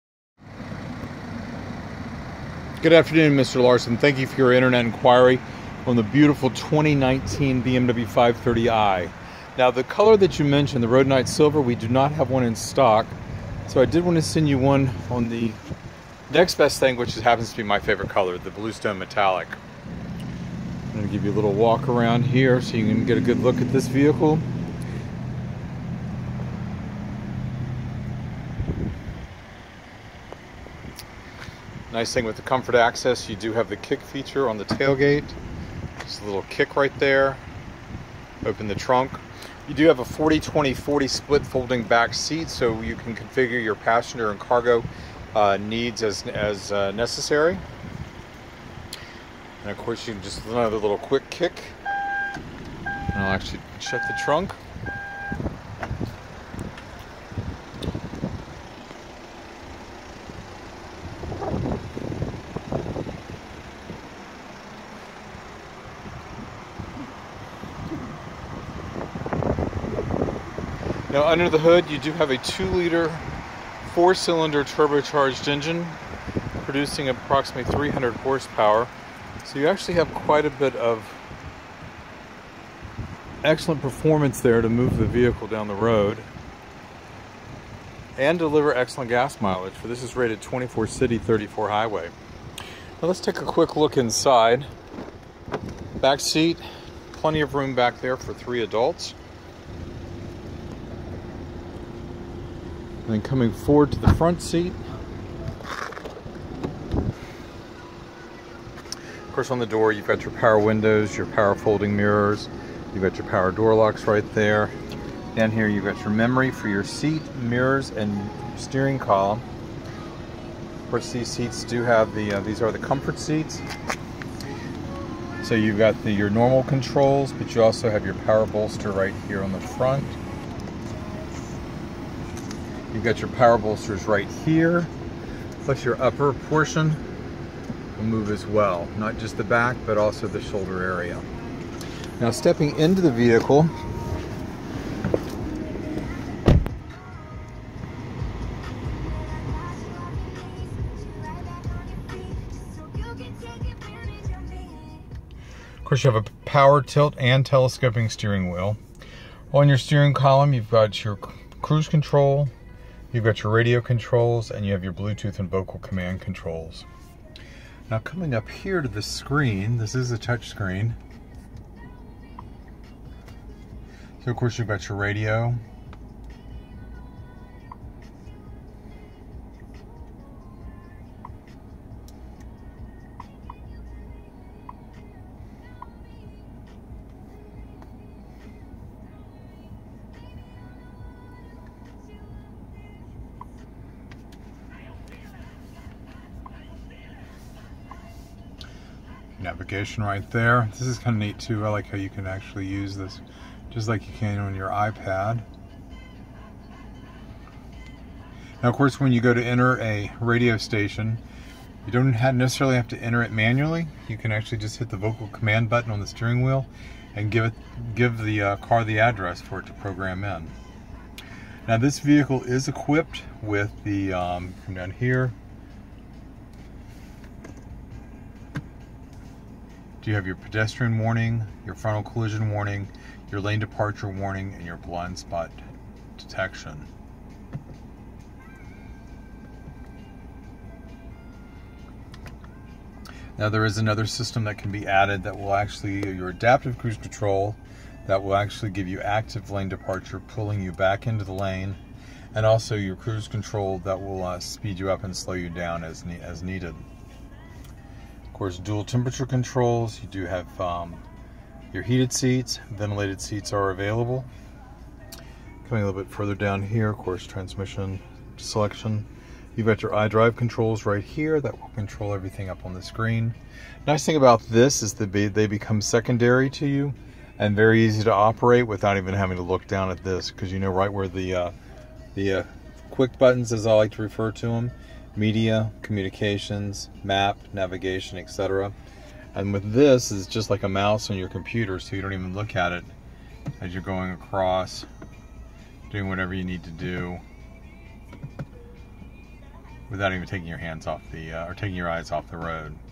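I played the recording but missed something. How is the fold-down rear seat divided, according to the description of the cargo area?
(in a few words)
40-20-40.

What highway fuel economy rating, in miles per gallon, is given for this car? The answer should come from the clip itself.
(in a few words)
34.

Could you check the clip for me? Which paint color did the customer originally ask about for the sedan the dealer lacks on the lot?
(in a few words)
Rhodonite Silver.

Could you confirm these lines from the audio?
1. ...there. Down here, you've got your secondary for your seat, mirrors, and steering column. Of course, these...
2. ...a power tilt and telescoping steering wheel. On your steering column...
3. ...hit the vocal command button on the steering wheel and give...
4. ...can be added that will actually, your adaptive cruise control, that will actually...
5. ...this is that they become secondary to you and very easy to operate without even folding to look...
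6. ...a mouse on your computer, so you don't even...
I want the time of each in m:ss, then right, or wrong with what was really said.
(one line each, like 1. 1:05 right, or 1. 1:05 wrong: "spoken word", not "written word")
1. 1:54 wrong: "memory", not "secondary"
2. 2:36 right
3. 3:34 right
4. 4:04 right
5. 4:34 wrong: "having", not "folding"
6. 4:50 right.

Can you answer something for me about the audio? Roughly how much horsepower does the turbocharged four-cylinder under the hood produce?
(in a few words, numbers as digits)
300.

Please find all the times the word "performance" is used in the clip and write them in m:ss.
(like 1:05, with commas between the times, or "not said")
1:23.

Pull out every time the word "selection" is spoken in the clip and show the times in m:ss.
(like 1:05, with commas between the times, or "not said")
4:28.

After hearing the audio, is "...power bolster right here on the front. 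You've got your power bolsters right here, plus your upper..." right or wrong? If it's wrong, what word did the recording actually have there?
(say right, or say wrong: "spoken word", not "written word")
right.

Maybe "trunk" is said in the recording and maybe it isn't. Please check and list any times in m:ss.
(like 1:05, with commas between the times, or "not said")
0:38, 0:54.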